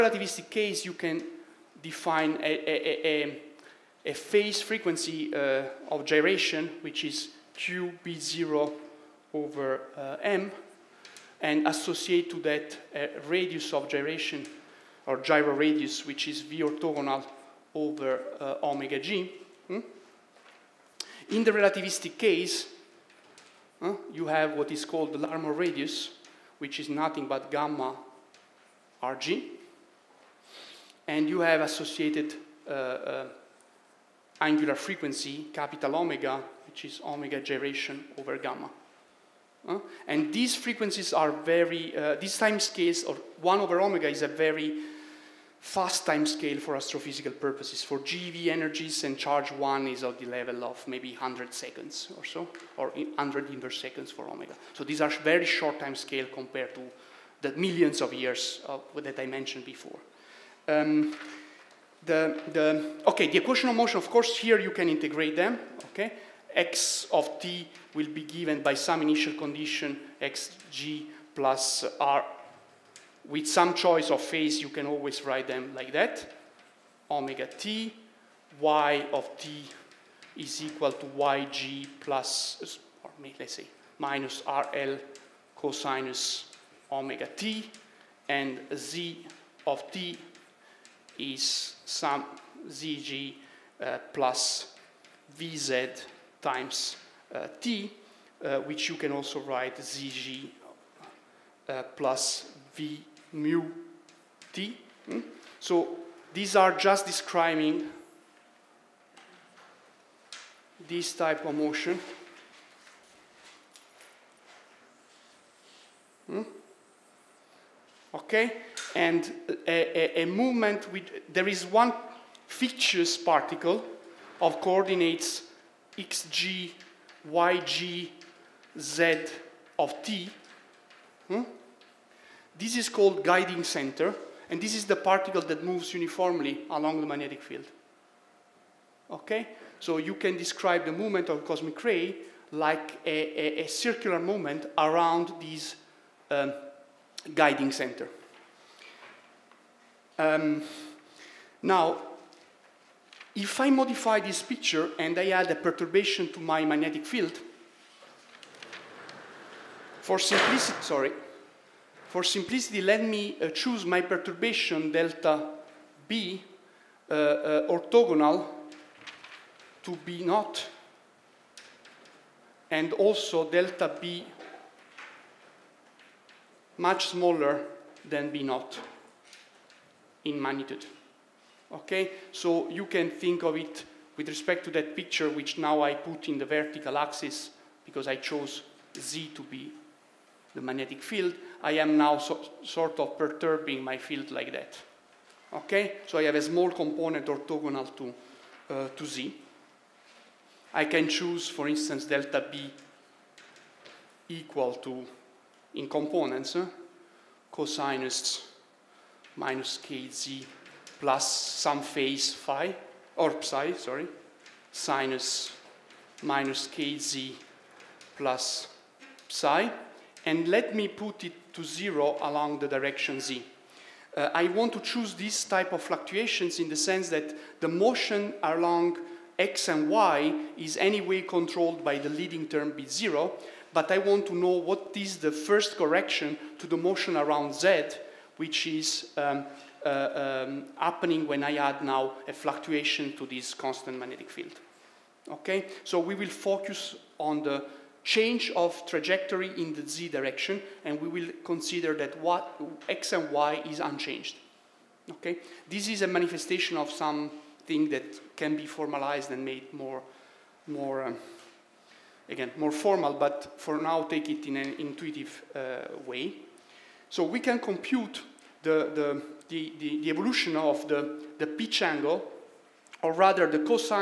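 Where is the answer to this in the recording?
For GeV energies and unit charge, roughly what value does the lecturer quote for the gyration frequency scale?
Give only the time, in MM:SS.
00:52.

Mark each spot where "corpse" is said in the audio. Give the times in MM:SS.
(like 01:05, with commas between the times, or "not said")
not said.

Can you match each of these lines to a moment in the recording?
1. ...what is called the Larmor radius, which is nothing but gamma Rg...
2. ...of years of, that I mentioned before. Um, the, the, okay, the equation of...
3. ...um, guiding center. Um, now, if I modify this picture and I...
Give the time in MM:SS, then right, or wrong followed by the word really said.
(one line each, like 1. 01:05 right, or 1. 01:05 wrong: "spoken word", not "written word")
1. 00:24 right
2. 00:58 right
3. 02:26 right.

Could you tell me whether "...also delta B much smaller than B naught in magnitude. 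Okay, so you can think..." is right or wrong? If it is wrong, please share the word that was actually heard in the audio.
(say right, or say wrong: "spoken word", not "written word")
right.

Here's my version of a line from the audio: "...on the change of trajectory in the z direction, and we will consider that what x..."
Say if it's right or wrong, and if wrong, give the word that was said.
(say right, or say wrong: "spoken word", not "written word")
right.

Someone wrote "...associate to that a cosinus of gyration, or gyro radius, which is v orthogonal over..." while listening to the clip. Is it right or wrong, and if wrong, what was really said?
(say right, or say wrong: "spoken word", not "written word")
wrong: "radius", not "cosinus".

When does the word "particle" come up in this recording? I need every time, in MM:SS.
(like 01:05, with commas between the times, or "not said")
02:03, 02:14.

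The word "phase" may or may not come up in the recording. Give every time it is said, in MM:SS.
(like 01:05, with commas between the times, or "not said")
00:04, 01:14, 03:31.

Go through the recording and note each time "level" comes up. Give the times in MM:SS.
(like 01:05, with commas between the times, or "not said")
00:50.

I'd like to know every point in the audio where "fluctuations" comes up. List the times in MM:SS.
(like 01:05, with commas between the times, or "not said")
03:45, 04:02.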